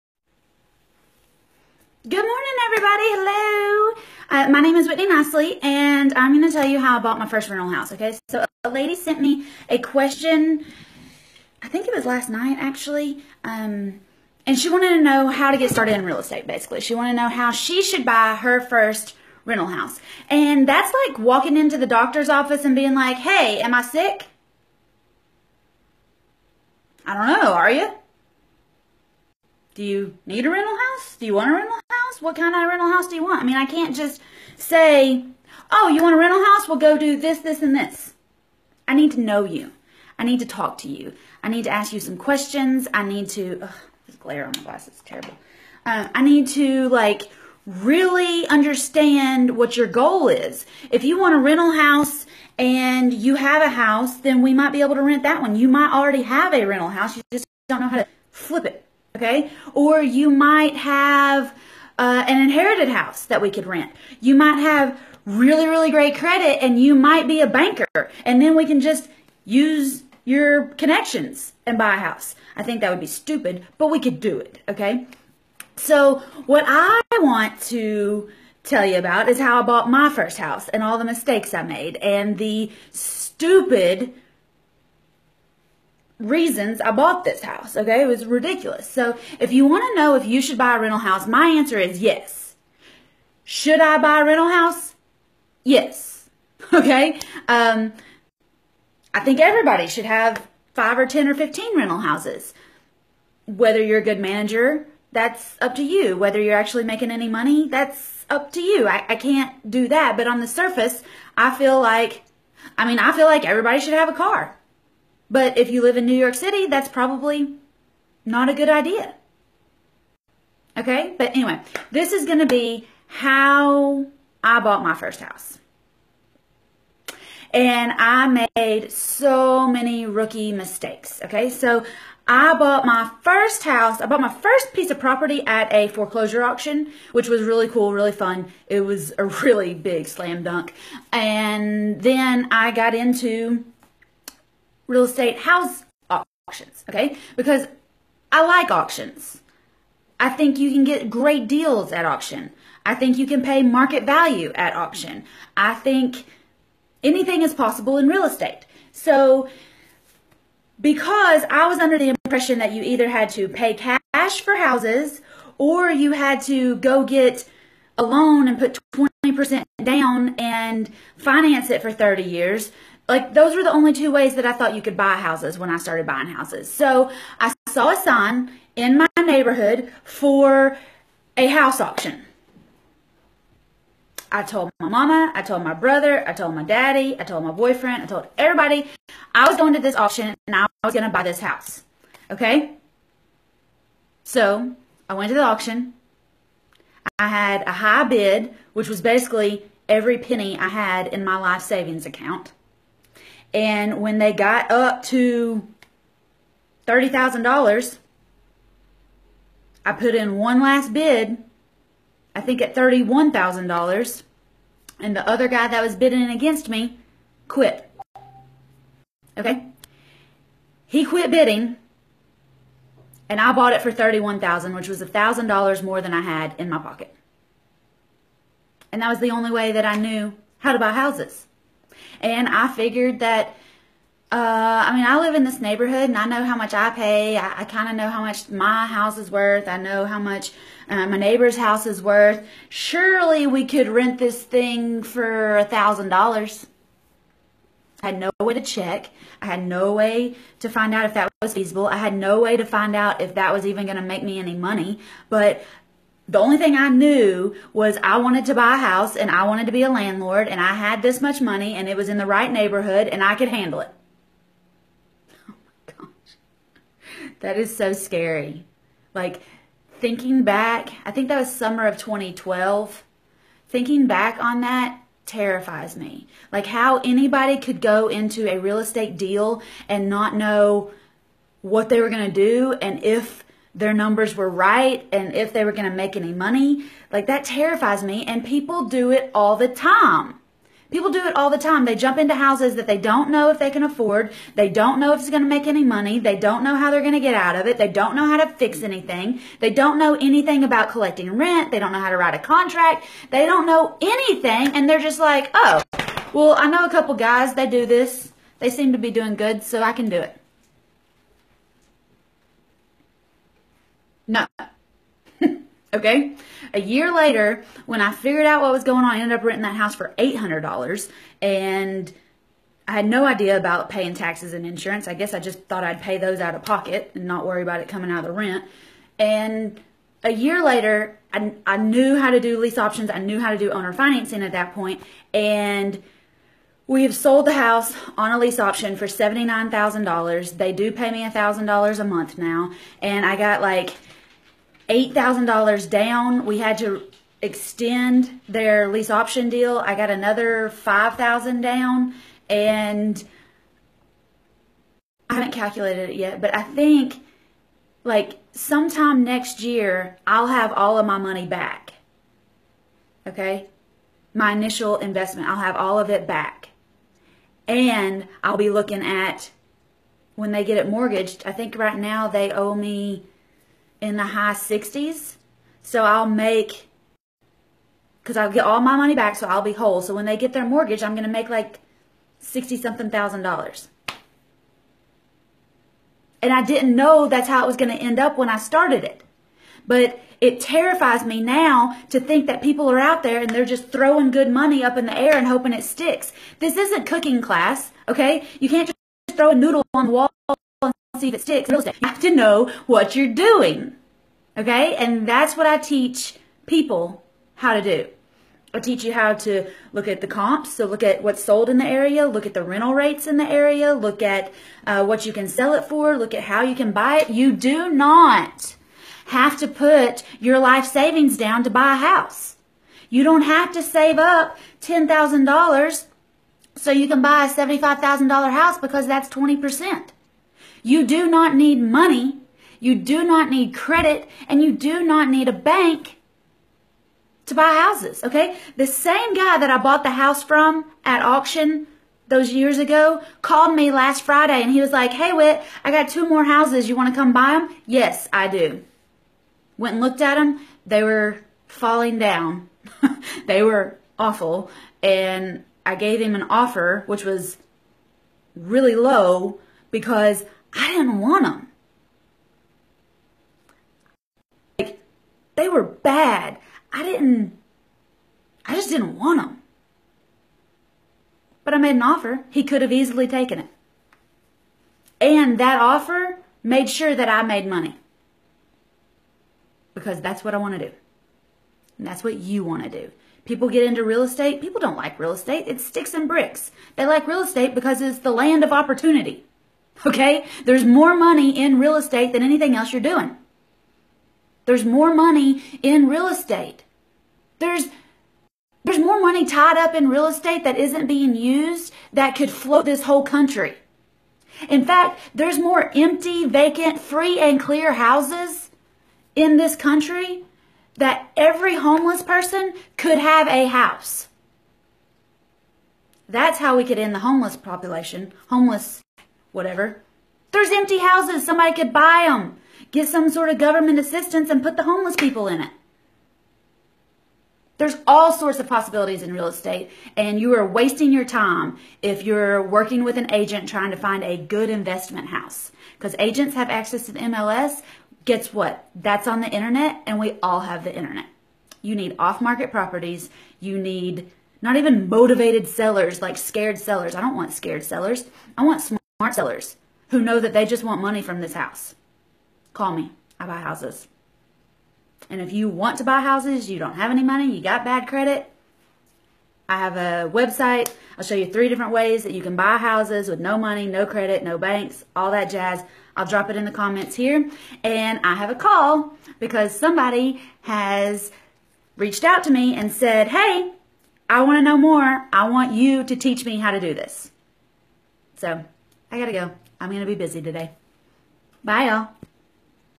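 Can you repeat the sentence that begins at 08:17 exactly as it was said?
There's there's more money tied up in real estate that isn't being used that could float this whole country.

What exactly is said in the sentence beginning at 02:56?
So I saw a sign in my neighborhood for a house auction.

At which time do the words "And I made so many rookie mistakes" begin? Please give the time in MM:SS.
02:07.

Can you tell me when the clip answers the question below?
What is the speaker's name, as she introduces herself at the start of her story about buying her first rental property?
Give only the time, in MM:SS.
00:04.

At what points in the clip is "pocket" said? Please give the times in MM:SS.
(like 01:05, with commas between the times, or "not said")
03:46, 05:26.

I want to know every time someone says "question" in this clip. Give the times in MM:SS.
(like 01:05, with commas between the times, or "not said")
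00:09, 00:42.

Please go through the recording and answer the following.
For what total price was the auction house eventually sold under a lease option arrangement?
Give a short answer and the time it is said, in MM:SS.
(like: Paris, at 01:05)
$79,000, at 05:39.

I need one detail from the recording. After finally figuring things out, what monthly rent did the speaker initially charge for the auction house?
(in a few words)
$800.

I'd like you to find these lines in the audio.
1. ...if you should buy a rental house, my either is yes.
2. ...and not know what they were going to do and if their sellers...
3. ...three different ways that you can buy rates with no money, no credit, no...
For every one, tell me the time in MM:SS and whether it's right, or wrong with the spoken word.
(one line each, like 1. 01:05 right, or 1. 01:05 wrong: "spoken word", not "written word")
1. 01:30 wrong: "answer", not "either"
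2. 04:39 wrong: "numbers", not "sellers"
3. 09:21 wrong: "houses", not "rates".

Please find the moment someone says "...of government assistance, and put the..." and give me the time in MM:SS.
08:43.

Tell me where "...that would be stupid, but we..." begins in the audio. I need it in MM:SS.
01:12.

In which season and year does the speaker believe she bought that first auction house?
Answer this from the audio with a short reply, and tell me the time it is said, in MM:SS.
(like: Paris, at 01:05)
Summer of 2012, at 04:31.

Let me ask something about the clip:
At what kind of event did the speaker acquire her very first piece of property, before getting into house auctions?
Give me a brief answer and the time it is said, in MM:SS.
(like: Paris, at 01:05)
Foreclosure auction, at 02:15.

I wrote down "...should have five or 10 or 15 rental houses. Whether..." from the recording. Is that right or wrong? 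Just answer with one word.
right.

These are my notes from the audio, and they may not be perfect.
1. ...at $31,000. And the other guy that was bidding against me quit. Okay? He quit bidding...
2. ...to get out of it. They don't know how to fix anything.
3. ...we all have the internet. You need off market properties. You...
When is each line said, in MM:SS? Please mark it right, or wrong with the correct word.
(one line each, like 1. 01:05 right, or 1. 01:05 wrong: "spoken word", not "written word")
1. 03:32 right
2. 04:57 right
3. 09:00 right.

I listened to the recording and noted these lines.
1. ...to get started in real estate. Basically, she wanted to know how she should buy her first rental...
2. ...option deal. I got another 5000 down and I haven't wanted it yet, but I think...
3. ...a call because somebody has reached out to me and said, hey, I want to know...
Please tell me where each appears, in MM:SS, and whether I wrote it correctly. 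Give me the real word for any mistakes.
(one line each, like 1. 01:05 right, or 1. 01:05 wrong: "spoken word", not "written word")
1. 00:15 right
2. 05:49 wrong: "calculated", not "wanted"
3. 09:28 right.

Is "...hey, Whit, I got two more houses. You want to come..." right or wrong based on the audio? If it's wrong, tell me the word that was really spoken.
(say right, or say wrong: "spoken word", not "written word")
right.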